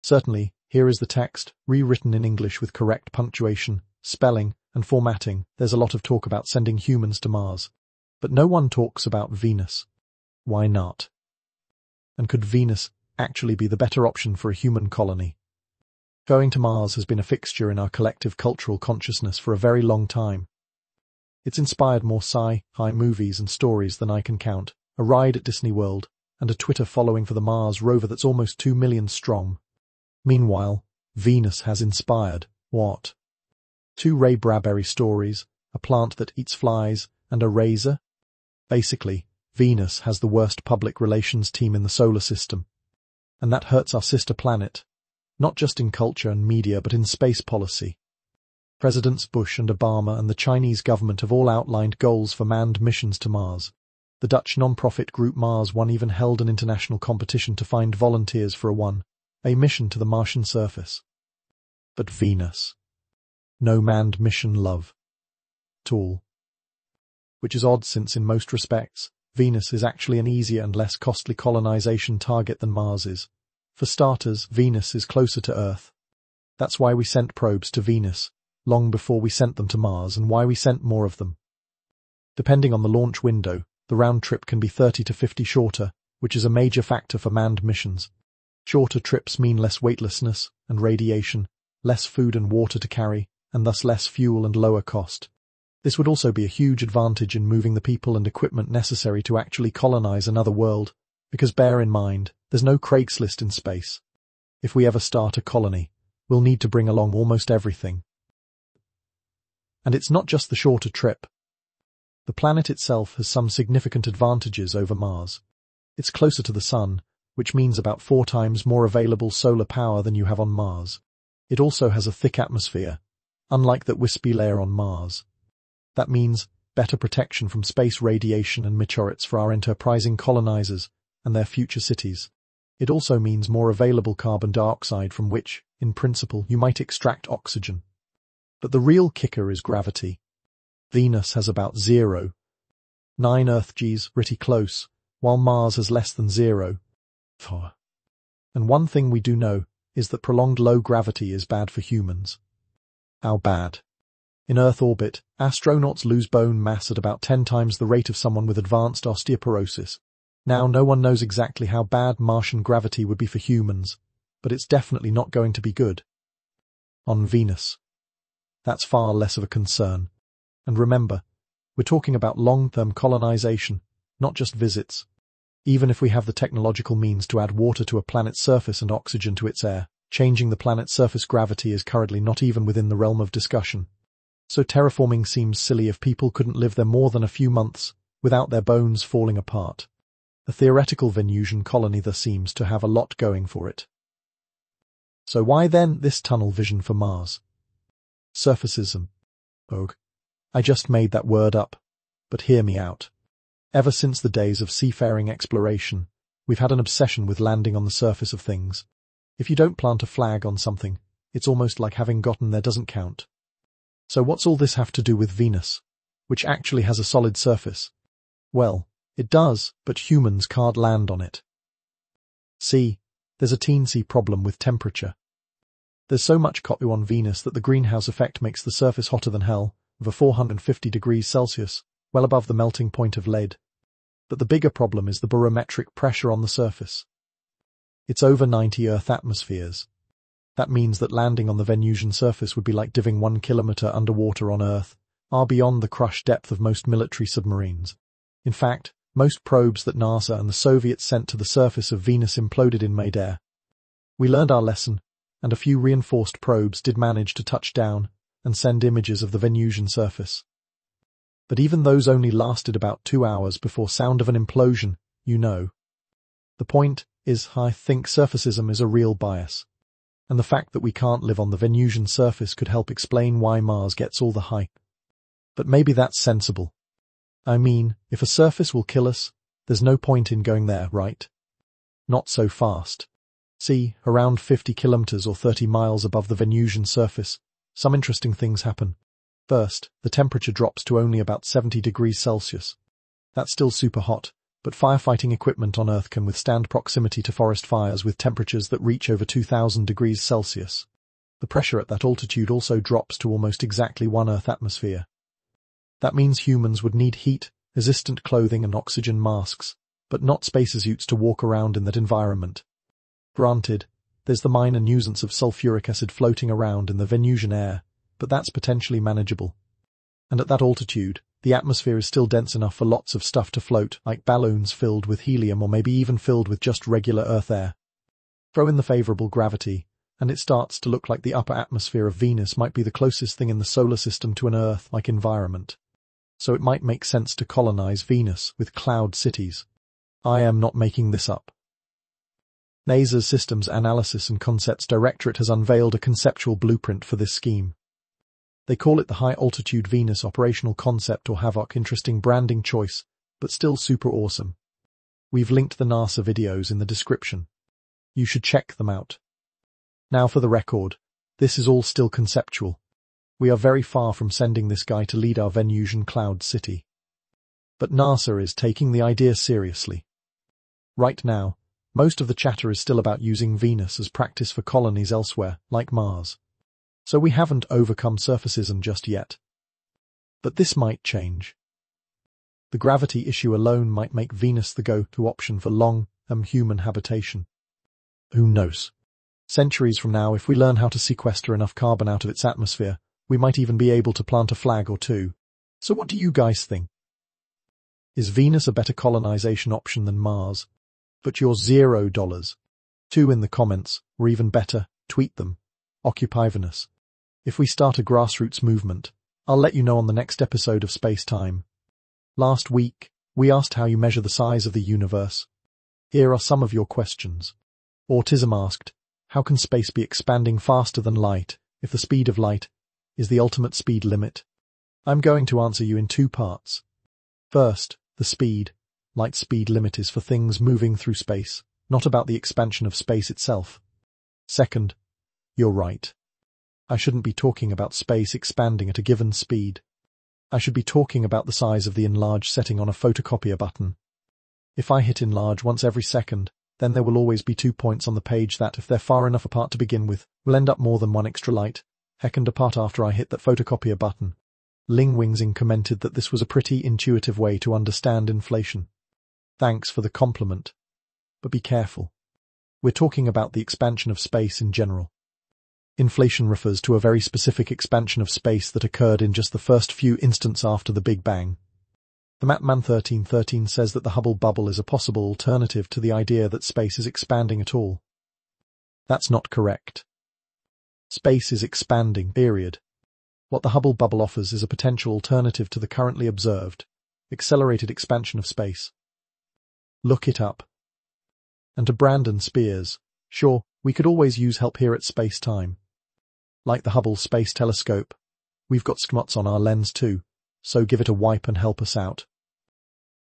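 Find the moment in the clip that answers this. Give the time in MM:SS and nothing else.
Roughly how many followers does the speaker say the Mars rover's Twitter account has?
00:28.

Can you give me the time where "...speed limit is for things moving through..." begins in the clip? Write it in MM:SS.
07:09.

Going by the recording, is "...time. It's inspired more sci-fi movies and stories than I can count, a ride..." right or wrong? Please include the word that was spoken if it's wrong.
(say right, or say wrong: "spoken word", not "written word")
right.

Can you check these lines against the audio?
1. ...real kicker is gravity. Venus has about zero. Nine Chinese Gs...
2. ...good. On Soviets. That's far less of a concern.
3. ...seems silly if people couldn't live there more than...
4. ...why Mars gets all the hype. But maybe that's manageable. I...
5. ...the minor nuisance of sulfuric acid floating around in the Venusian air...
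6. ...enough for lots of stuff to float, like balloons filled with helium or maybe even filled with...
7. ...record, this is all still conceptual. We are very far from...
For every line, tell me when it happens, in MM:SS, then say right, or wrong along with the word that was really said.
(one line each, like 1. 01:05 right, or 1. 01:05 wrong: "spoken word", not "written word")
1. 02:18 wrong: "Earth", not "Chinese"
2. 02:45 wrong: "Venus", not "Soviets"
3. 03:05 right
4. 04:33 wrong: "sensible", not "manageable"
5. 05:14 right
6. 05:22 right
7. 06:00 right.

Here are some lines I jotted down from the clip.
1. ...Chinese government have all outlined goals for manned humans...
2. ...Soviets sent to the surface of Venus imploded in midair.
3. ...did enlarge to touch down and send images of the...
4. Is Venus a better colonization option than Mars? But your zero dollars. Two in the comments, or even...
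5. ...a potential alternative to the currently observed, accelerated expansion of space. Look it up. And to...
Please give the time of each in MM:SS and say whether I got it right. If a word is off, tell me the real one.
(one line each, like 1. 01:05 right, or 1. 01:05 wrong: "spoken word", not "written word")
1. 00:50 wrong: "missions", not "humans"
2. 04:10 right
3. 04:16 wrong: "manage", not "enlarge"
4. 06:38 right
5. 08:04 right.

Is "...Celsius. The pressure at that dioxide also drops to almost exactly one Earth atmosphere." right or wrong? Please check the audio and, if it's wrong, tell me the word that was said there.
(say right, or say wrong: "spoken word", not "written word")
wrong: "altitude", not "dioxide".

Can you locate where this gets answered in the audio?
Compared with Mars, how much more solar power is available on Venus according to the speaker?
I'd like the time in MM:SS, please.
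01:58.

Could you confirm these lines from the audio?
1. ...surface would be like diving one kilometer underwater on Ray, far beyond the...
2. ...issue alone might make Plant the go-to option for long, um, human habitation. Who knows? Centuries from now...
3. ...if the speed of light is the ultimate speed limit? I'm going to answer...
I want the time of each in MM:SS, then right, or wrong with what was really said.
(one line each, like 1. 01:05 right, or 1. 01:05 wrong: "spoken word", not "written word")
1. 04:02 wrong: "Earth", not "Ray"
2. 06:23 wrong: "Venus", not "Plant"
3. 07:01 right.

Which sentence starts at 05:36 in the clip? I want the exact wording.
So it might make sense to colonize Venus with cloud cities.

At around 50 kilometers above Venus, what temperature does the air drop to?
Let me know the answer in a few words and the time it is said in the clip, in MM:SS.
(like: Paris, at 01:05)
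about 70 degrees Celsius, at 04:51.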